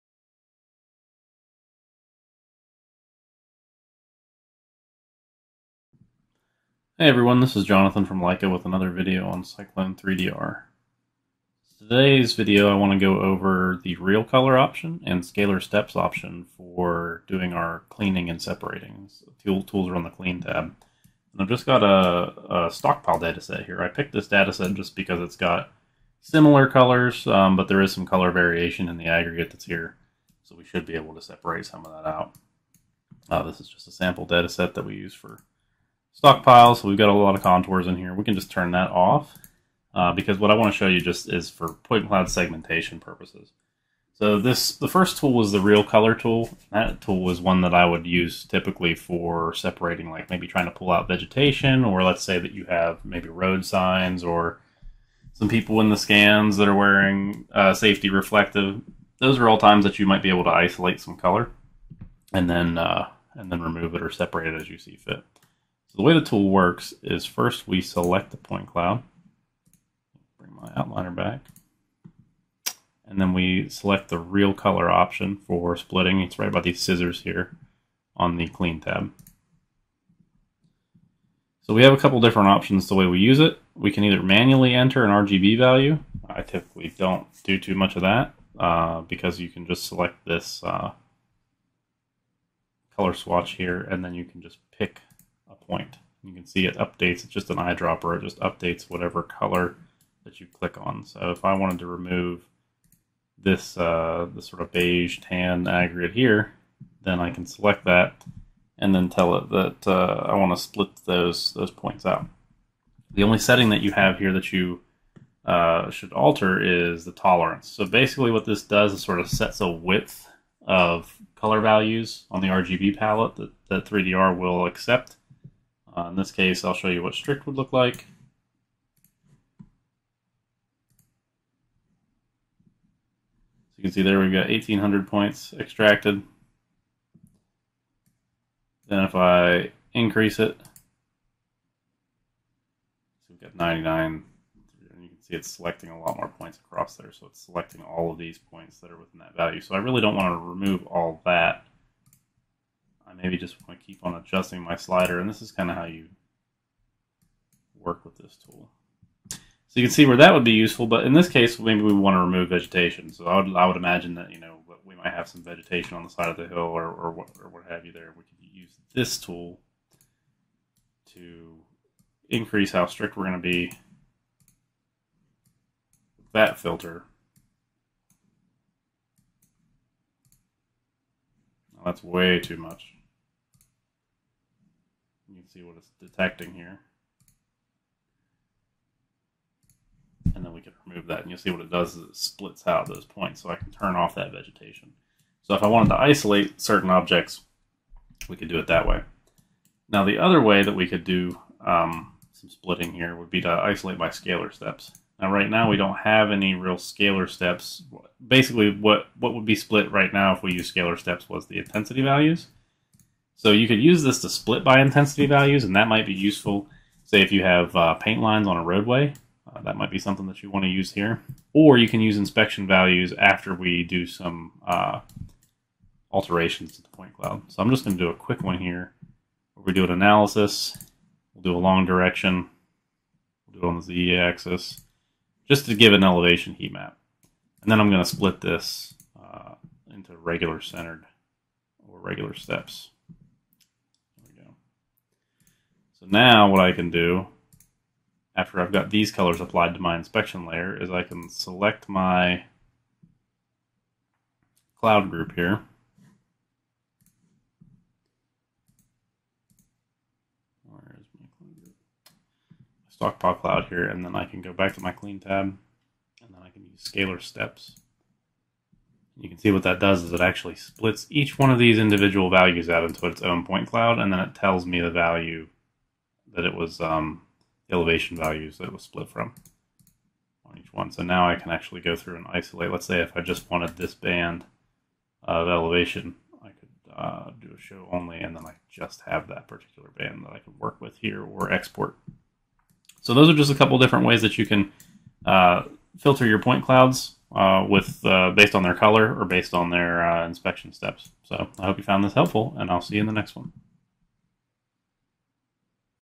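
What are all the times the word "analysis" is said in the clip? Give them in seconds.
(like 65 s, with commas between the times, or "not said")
229 s.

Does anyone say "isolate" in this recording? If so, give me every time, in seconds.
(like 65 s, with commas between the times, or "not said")
60 s, 195 s, 203 s, 282 s.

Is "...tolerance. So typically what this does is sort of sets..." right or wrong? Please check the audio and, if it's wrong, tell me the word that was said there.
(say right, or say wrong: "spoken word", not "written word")
wrong: "basically", not "typically".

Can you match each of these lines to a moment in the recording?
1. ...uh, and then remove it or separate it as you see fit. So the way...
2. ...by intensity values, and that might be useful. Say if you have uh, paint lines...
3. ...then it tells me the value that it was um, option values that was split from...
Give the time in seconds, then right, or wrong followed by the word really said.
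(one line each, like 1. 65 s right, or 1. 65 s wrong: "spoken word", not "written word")
1. 62 s right
2. 214 s right
3. 274 s wrong: "elevation", not "option".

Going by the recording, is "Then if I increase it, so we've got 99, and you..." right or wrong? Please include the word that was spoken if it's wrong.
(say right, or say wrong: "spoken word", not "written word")
right.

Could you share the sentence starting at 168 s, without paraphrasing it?
We could use this tool to increase how strict we're going to be with that filter.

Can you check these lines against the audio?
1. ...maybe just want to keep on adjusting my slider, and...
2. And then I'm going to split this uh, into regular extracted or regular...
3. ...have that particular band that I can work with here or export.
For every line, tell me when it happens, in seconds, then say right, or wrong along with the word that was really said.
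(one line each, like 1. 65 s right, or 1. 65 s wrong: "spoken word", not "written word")
1. 153 s right
2. 237 s wrong: "centered", not "extracted"
3. 289 s right.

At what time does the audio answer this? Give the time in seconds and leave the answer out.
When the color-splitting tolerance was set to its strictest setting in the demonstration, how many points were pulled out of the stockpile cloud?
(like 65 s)
134 s.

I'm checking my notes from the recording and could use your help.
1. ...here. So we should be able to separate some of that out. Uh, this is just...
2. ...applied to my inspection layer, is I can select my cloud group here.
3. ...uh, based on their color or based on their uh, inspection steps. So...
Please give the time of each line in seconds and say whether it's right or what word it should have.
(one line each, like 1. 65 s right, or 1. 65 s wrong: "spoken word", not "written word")
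1. 29 s right
2. 249 s right
3. 298 s right.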